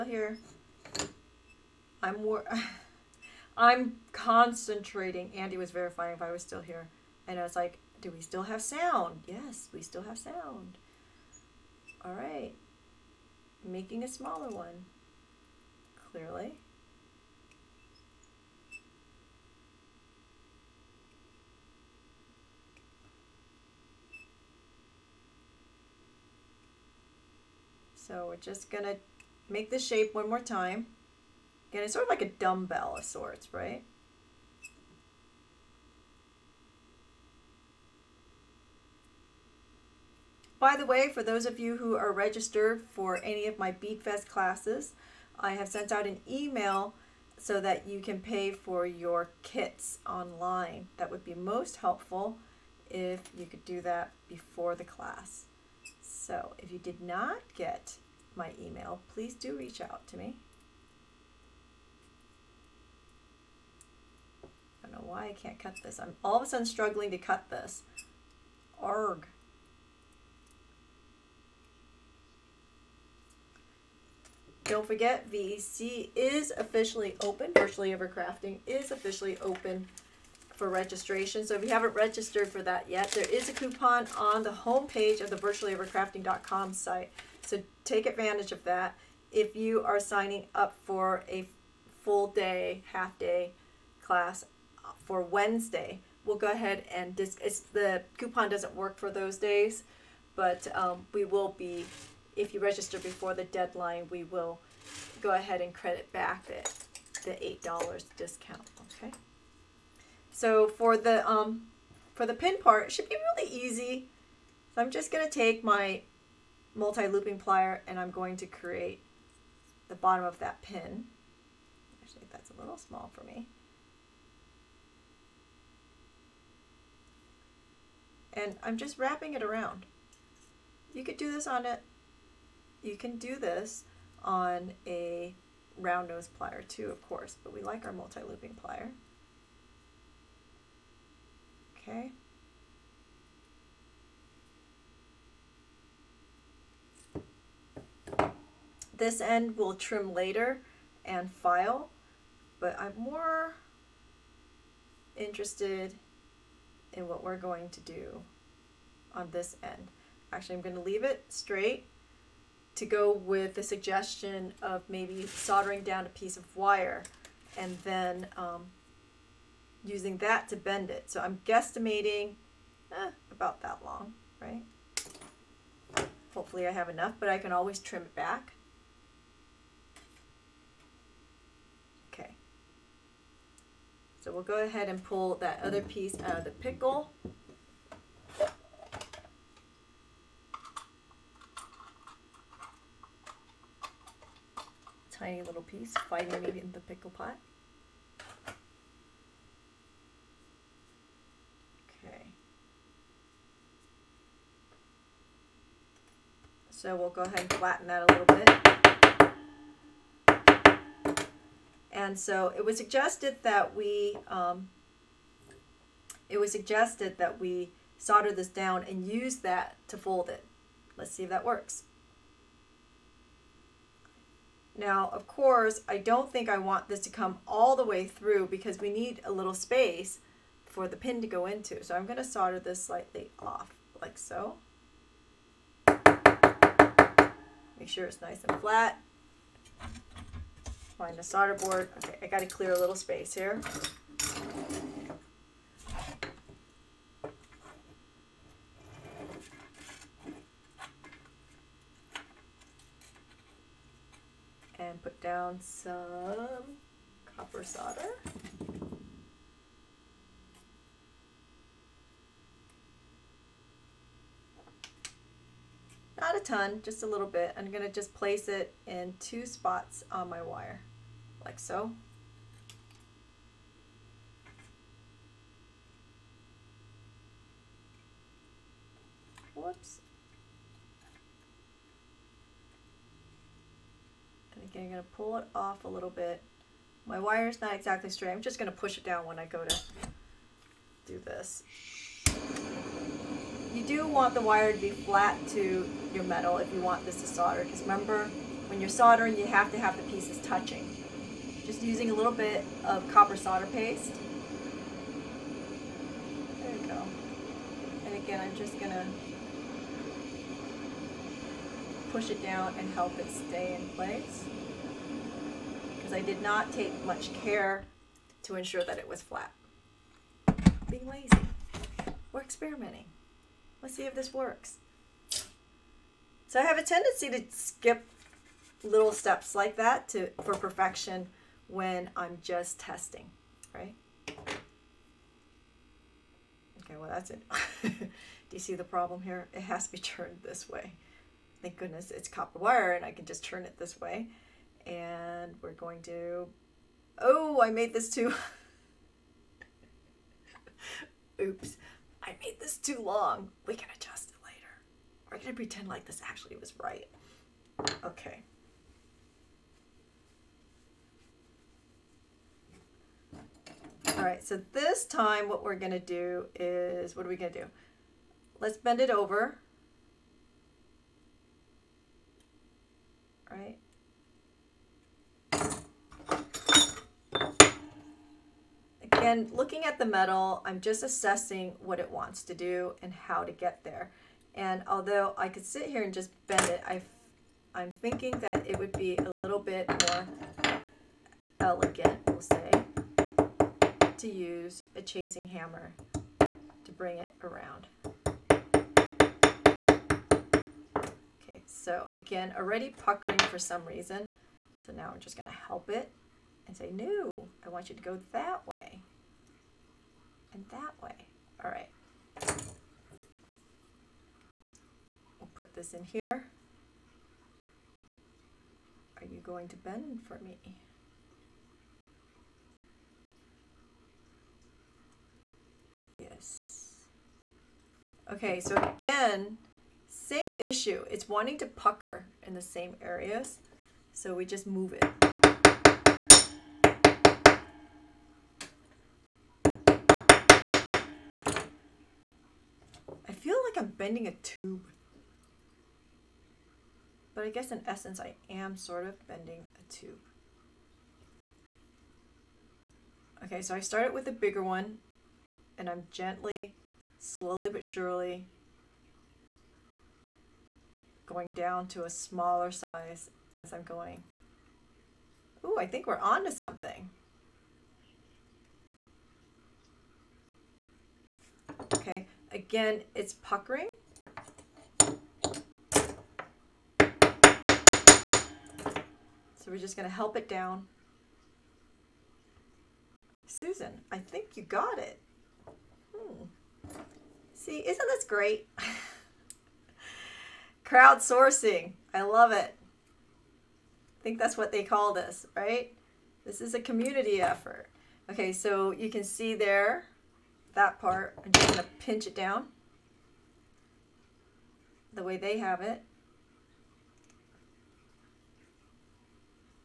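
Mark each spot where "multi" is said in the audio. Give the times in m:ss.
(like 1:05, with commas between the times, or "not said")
1:56, 2:17.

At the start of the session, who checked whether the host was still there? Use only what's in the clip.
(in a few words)
Andy.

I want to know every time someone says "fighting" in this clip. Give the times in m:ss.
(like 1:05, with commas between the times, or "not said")
3:16.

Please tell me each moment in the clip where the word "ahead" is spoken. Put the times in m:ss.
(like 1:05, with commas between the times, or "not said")
1:36, 1:45, 3:04, 3:27.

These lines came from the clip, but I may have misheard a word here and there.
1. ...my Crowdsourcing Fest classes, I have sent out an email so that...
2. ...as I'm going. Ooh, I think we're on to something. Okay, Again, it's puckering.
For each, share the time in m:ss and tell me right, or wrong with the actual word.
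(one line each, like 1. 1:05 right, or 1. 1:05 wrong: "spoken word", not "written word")
1. 0:43 wrong: "Bead", not "Crowdsourcing"
2. 7:43 right.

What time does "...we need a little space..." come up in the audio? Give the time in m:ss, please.
3:48.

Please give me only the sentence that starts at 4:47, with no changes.
My wire is not exactly straight.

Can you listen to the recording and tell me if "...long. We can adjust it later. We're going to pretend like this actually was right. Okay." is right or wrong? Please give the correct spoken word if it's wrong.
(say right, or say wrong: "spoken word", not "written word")
right.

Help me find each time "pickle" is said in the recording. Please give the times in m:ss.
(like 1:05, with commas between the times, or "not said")
3:06, 3:16.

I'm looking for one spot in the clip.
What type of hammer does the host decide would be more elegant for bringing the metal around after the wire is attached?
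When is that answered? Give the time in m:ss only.
6:35.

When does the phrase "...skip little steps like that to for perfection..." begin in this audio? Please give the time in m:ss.
5:27.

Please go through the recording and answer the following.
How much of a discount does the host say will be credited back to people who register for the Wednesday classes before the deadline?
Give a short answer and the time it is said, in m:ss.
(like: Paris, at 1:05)
$8, at 1:47.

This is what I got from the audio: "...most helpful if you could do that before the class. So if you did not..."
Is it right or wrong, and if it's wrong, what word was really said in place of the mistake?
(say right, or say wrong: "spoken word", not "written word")
right.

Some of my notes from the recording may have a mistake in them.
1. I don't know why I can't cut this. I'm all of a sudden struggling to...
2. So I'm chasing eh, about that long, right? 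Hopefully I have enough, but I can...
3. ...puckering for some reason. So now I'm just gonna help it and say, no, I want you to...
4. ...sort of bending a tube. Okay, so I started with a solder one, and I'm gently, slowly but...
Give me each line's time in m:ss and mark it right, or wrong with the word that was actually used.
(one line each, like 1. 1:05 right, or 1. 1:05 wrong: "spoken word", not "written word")
1. 1:04 right
2. 2:51 wrong: "guesstimating", not "chasing"
3. 6:43 right
4. 7:28 wrong: "bigger", not "solder".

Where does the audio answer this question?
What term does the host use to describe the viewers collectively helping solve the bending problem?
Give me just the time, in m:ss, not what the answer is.
8:10.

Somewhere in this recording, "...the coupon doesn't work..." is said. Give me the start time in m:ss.
1:37.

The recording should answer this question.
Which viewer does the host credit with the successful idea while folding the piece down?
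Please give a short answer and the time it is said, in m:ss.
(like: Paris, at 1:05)
Susan, at 8:03.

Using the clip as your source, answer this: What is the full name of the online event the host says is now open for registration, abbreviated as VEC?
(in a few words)
Virtually Ever Crafting.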